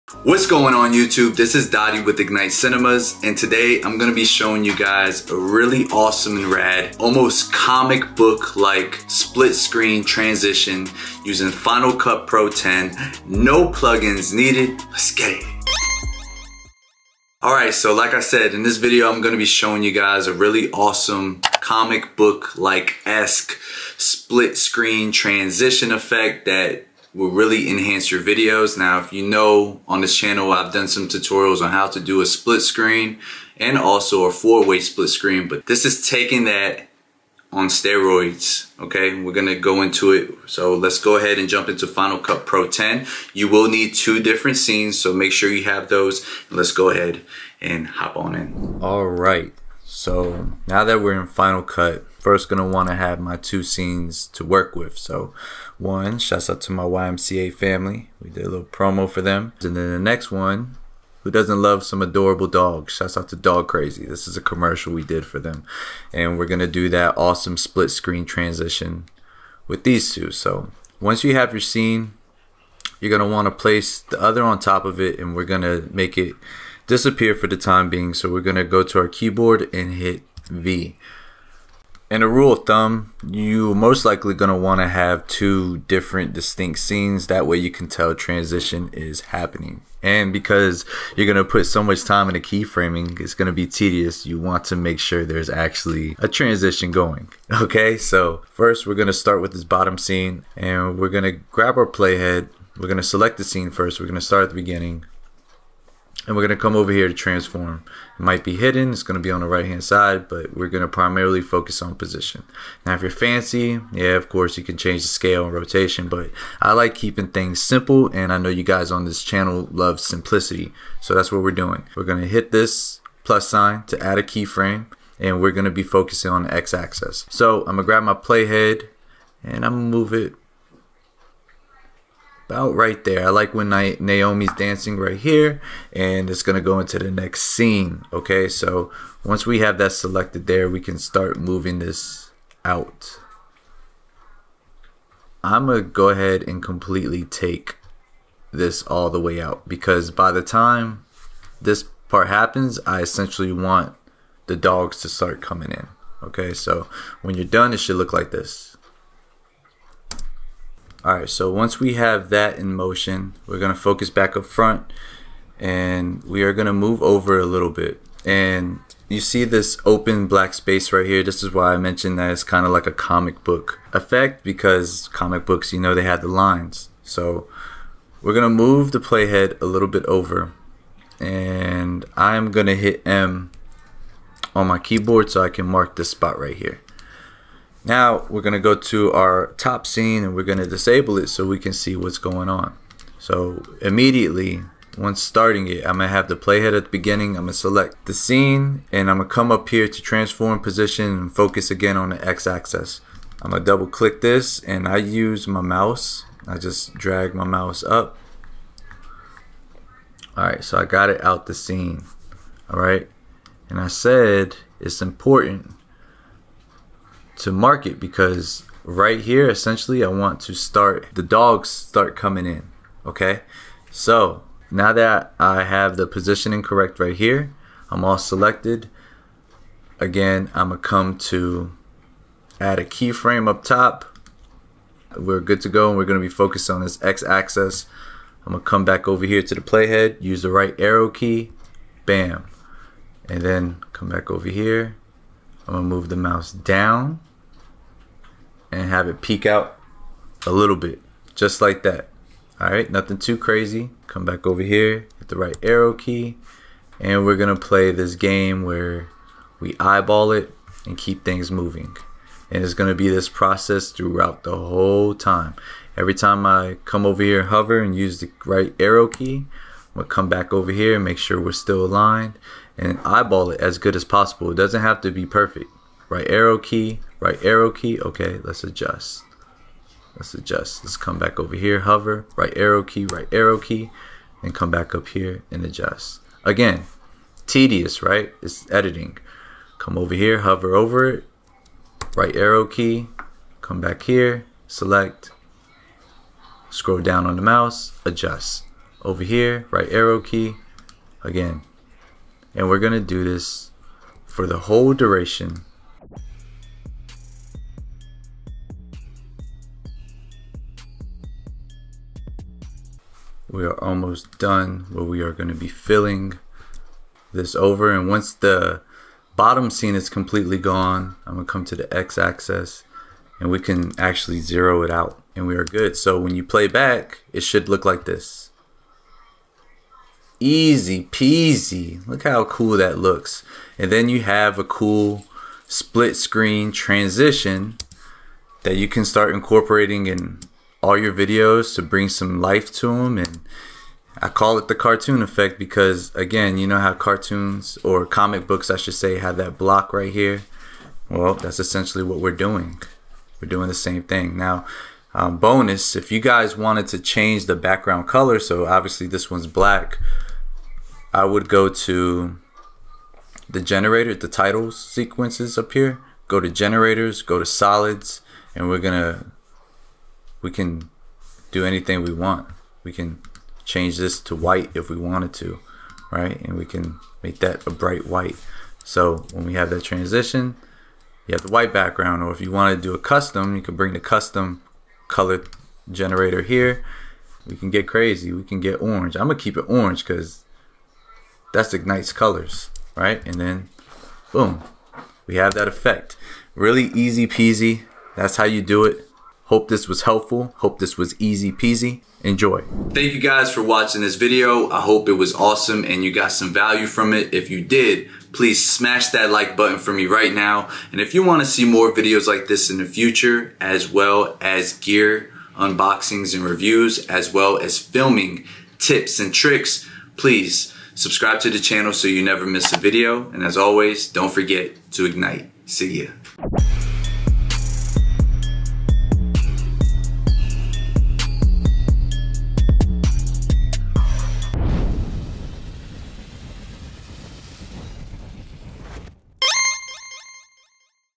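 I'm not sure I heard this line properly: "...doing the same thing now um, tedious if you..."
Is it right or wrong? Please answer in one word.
wrong.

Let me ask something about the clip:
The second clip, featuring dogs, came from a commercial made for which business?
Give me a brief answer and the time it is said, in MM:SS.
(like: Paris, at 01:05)
Dog Crazy, at 01:03.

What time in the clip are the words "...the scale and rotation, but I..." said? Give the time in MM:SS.
01:55.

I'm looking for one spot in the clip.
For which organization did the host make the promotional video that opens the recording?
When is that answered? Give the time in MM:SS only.
00:56.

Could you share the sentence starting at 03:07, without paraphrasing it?
Now we're going to go to our top scene and we're going to disable it so we can see what's going on.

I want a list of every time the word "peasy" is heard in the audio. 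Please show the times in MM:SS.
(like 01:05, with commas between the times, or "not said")
05:31, 06:37, 06:41.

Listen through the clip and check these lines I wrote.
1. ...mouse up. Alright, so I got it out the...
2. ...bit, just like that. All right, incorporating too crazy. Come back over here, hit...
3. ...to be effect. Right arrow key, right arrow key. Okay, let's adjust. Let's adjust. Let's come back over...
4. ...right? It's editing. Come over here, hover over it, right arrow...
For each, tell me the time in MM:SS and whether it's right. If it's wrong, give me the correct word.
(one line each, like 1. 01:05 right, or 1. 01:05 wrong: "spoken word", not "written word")
1. 03:27 right
2. 04:10 wrong: "nothing", not "incorporating"
3. 04:35 wrong: "perfect", not "effect"
4. 04:48 right.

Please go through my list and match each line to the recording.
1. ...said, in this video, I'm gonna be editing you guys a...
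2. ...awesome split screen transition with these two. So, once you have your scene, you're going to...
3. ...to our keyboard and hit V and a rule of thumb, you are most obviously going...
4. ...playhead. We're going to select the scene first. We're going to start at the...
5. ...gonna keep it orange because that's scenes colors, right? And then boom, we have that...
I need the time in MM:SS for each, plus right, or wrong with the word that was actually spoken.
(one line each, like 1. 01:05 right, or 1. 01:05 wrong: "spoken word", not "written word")
1. 00:18 wrong: "showing", not "editing"
2. 01:07 right
3. 01:18 wrong: "likely", not "obviously"
4. 01:41 right
5. 06:29 wrong: "ignites", not "scenes".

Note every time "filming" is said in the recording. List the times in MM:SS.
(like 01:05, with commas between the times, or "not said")
06:57.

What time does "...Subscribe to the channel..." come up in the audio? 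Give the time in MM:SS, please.
07:01.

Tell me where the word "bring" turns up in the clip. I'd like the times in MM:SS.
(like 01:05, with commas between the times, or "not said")
05:41, 06:23.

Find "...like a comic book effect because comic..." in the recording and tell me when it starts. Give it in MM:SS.
02:52.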